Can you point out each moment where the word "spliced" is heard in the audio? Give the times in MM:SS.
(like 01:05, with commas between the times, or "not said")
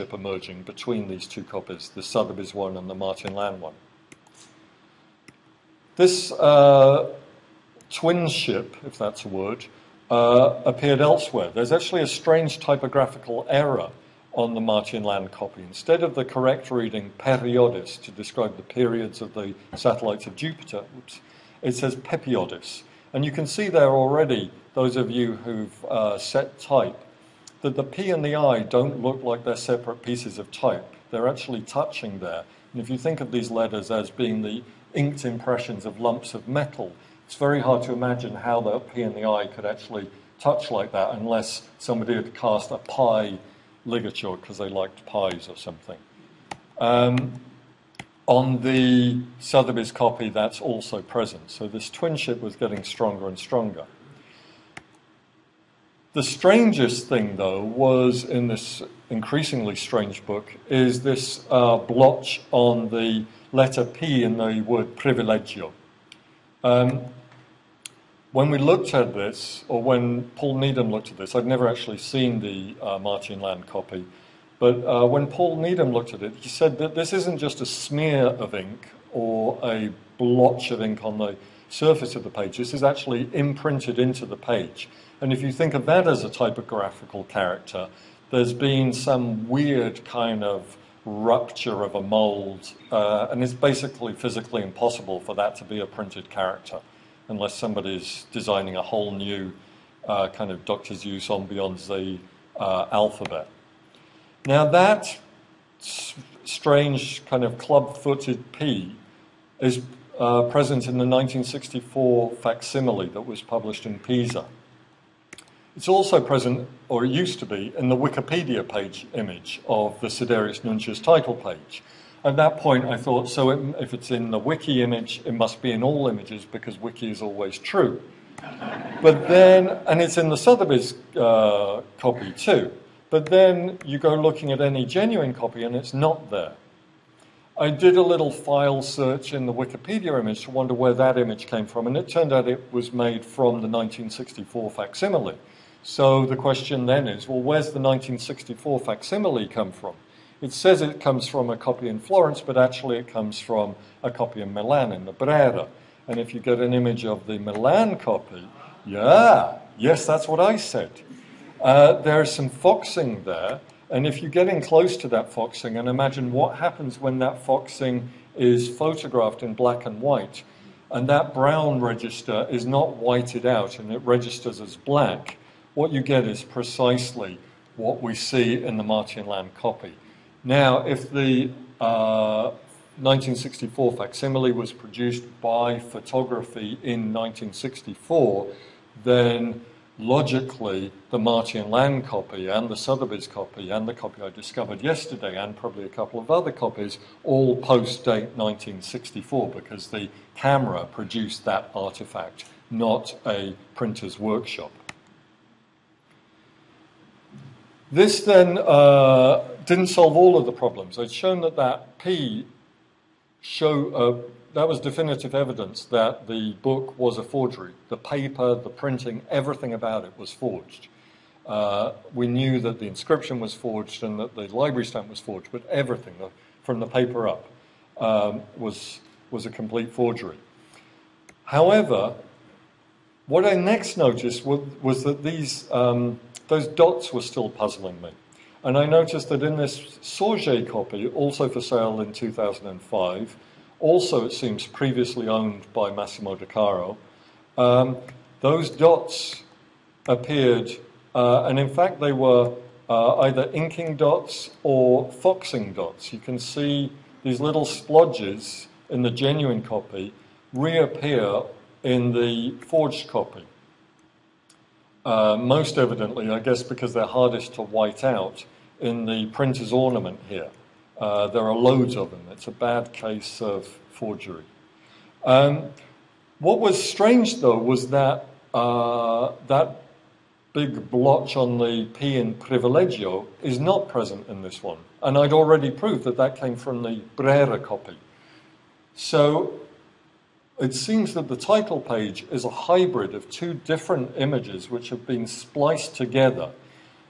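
04:55.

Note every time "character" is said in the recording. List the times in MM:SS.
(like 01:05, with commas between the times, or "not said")
01:27, 01:36.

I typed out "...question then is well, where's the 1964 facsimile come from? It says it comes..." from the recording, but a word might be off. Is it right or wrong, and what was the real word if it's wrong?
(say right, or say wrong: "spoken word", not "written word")
right.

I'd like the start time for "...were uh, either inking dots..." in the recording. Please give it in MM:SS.
04:12.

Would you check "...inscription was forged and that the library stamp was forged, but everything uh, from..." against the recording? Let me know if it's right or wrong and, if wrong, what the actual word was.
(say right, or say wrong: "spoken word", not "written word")
right.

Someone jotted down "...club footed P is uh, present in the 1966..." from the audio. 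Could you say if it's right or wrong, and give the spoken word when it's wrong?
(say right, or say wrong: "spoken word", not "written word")
wrong: "1964", not "1966".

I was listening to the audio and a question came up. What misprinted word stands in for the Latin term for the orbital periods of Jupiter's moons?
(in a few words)
pepiodis.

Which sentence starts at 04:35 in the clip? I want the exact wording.
Um, what was strange, though, was that uh, that big blotch on the P in Privilegio is not present in this one.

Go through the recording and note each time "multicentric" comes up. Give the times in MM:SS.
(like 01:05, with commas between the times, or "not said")
not said.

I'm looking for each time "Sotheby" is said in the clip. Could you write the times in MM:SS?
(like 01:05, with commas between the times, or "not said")
00:02, 00:49, 02:10, 03:12.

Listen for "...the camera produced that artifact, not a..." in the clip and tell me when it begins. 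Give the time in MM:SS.
03:19.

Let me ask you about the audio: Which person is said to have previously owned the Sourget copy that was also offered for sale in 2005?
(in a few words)
Massimo De Caro.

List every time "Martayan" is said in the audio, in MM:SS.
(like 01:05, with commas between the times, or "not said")
00:02, 00:14, 01:12, 02:58, 03:11.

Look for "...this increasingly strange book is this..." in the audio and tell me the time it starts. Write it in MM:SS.
00:58.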